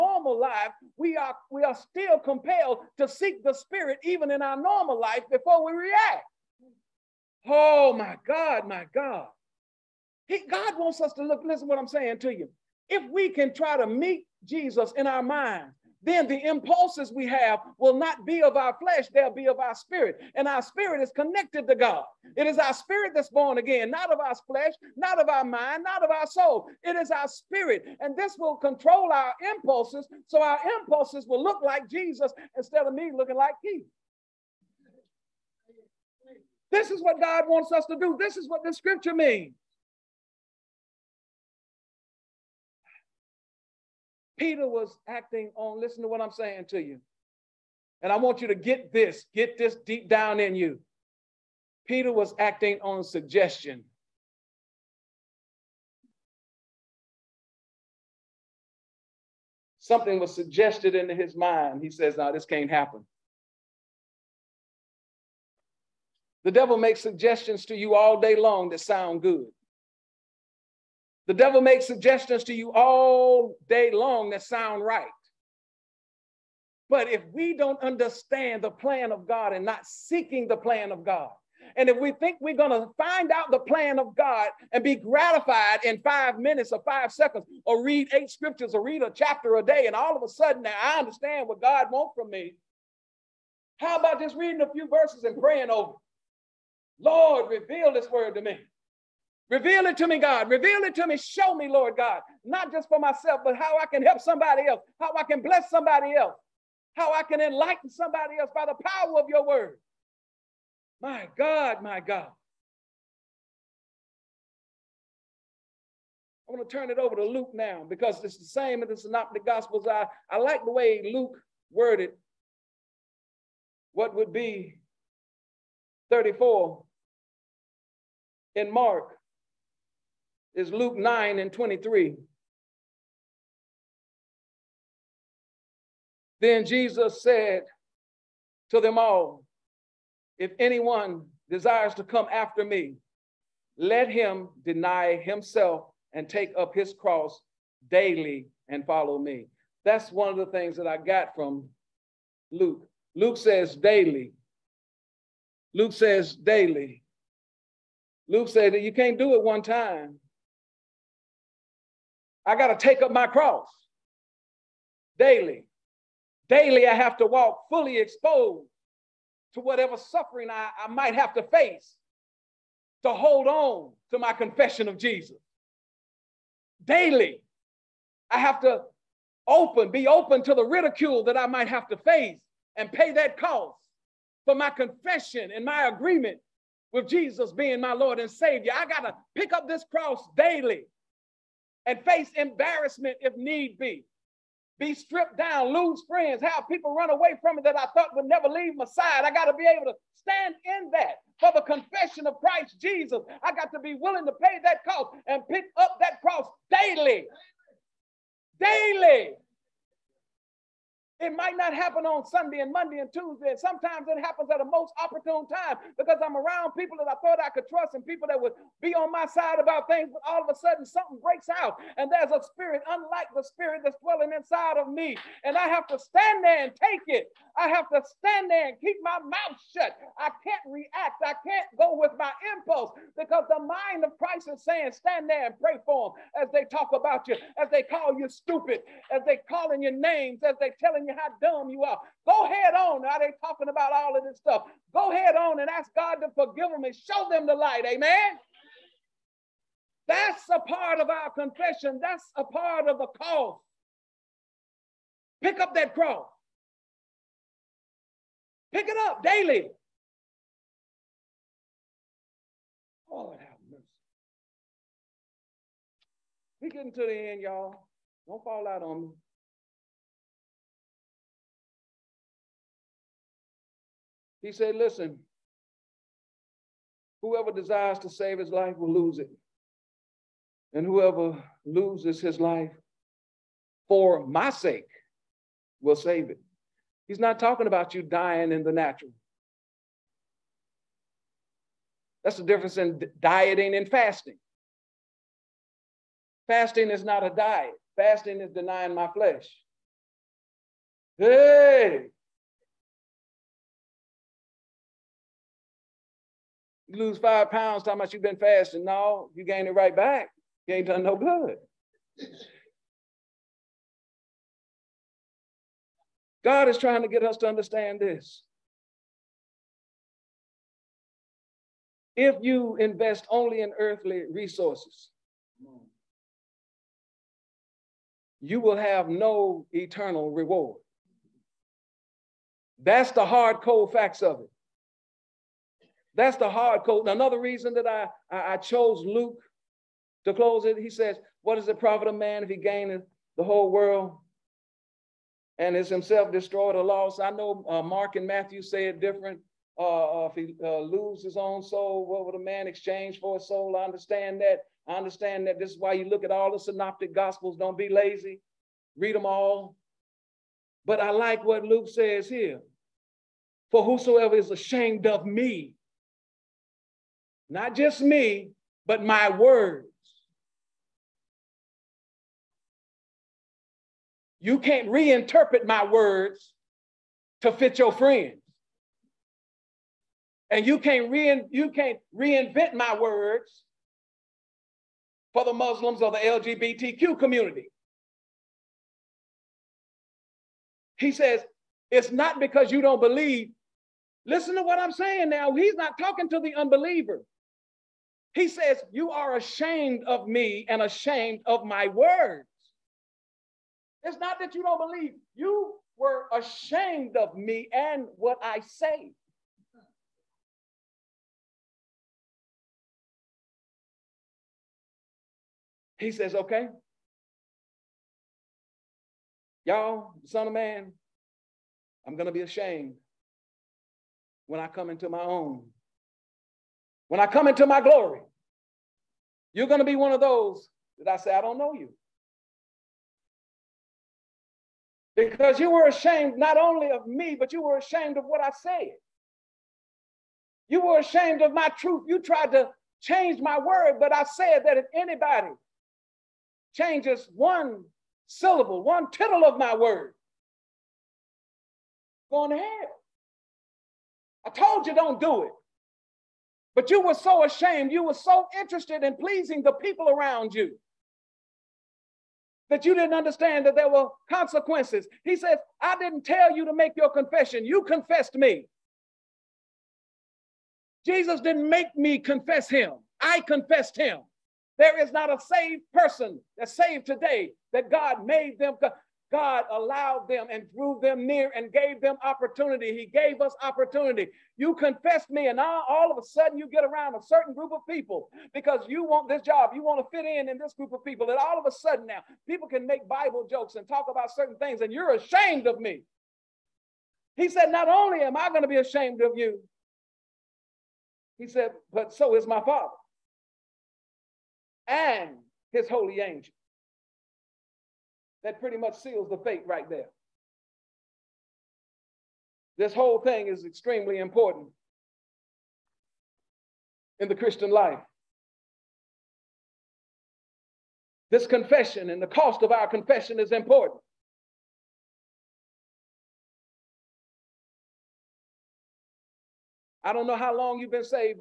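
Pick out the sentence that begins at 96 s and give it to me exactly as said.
Lord, reveal this word to me.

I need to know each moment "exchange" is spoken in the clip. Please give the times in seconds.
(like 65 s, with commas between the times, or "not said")
352 s.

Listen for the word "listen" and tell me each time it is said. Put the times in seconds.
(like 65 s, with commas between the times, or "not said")
11 s, 45 s, 274 s, 394 s.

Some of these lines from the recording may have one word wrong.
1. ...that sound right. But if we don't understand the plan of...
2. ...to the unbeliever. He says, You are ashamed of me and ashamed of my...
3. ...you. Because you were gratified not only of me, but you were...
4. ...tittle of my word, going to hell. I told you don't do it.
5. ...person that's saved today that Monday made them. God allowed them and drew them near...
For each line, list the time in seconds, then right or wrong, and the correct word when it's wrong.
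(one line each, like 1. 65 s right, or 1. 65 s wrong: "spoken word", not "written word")
1. 74 s right
2. 396 s right
3. 431 s wrong: "ashamed", not "gratified"
4. 449 s right
5. 475 s wrong: "God", not "Monday".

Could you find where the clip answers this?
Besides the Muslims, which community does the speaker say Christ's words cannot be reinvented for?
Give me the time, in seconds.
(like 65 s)
386 s.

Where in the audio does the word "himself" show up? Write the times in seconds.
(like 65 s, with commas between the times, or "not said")
145 s, 345 s.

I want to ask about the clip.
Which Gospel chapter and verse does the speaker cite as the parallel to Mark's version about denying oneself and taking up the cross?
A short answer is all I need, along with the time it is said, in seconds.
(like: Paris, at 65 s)
Luke 9:23, at 130 s.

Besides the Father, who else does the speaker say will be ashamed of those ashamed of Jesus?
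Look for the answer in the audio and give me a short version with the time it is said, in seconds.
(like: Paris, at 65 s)
His holy angels, at 505 s.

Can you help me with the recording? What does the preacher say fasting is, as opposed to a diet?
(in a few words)
Denying my flesh.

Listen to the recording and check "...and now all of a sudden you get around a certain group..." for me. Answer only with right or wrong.
right.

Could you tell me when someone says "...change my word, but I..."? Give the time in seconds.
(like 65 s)
443 s.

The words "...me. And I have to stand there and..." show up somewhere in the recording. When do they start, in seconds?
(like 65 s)
224 s.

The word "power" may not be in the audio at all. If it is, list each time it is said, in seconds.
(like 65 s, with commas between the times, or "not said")
108 s.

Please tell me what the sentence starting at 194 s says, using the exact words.
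Be stripped down, lose friends, have people run away from me that I thought would never leave my side.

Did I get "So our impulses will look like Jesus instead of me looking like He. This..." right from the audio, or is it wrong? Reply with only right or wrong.
right.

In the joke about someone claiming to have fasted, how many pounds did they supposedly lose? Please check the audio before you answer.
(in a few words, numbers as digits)
5.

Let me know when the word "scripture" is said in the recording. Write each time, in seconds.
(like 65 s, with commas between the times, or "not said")
38 s, 88 s.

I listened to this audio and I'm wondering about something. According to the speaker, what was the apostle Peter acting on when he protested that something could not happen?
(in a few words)
Suggestion.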